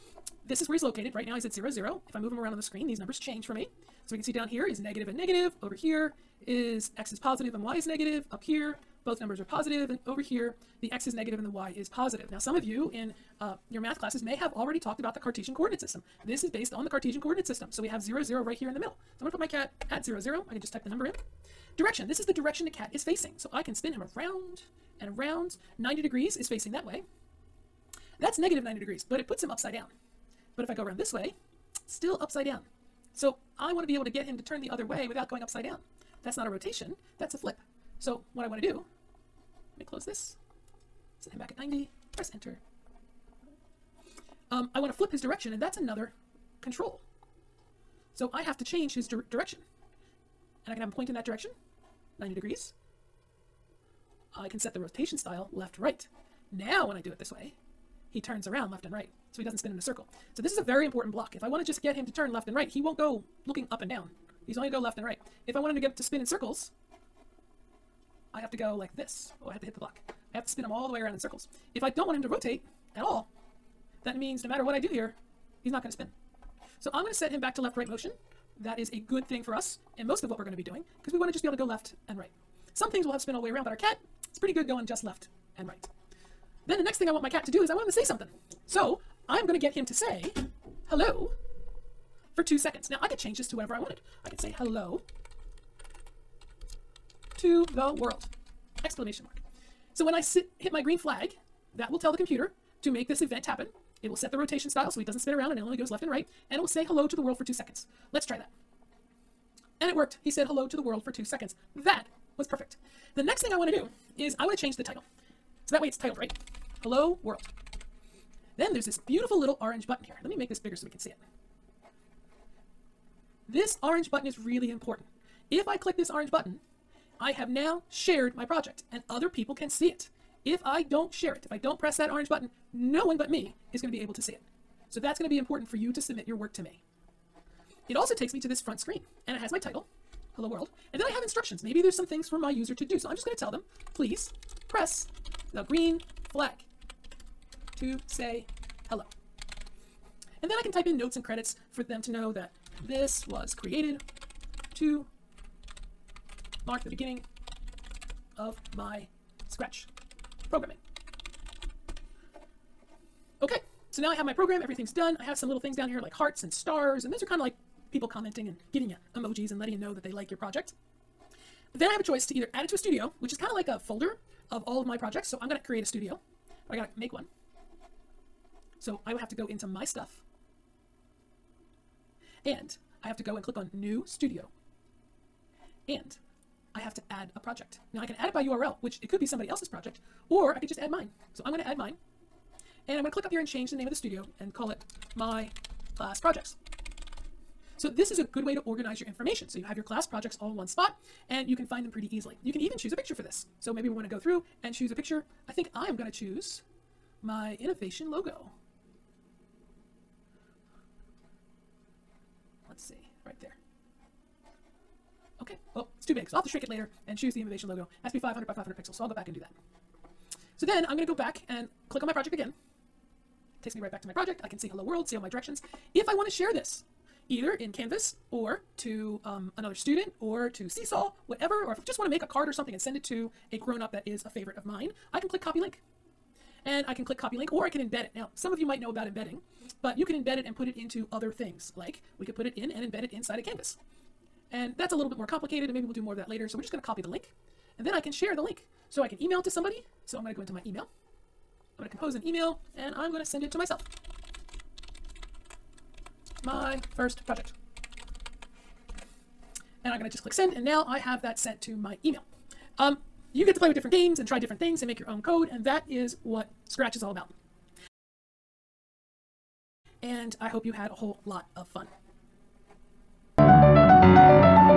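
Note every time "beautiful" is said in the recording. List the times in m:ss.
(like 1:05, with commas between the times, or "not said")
1:59.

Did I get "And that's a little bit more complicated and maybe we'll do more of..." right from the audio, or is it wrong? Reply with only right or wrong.
right.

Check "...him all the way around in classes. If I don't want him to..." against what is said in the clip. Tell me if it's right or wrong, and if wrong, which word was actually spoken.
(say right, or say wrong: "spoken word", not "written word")
wrong: "circles", not "classes".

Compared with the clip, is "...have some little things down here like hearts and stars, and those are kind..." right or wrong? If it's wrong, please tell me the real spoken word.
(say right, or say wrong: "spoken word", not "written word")
right.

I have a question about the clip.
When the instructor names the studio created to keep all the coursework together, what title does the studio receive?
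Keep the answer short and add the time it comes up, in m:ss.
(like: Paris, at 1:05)
My Class Projects, at 3:15.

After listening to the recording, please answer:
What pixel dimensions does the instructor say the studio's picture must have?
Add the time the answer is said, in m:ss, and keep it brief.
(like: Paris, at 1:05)
500 by 500, at 3:38.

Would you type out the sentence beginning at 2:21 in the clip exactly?
Maybe there's some things for my user to do.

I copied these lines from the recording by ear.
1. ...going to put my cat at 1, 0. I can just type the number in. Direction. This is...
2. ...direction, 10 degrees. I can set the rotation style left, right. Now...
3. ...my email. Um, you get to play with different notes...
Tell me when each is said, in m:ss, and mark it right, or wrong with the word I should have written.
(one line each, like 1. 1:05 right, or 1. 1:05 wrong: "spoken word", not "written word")
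1. 0:19 wrong: "0", not "1"
2. 0:51 wrong: "90", not "10"
3. 4:21 wrong: "games", not "notes".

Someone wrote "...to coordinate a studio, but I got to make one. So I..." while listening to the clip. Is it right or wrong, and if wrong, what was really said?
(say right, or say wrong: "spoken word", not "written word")
wrong: "create", not "coordinate".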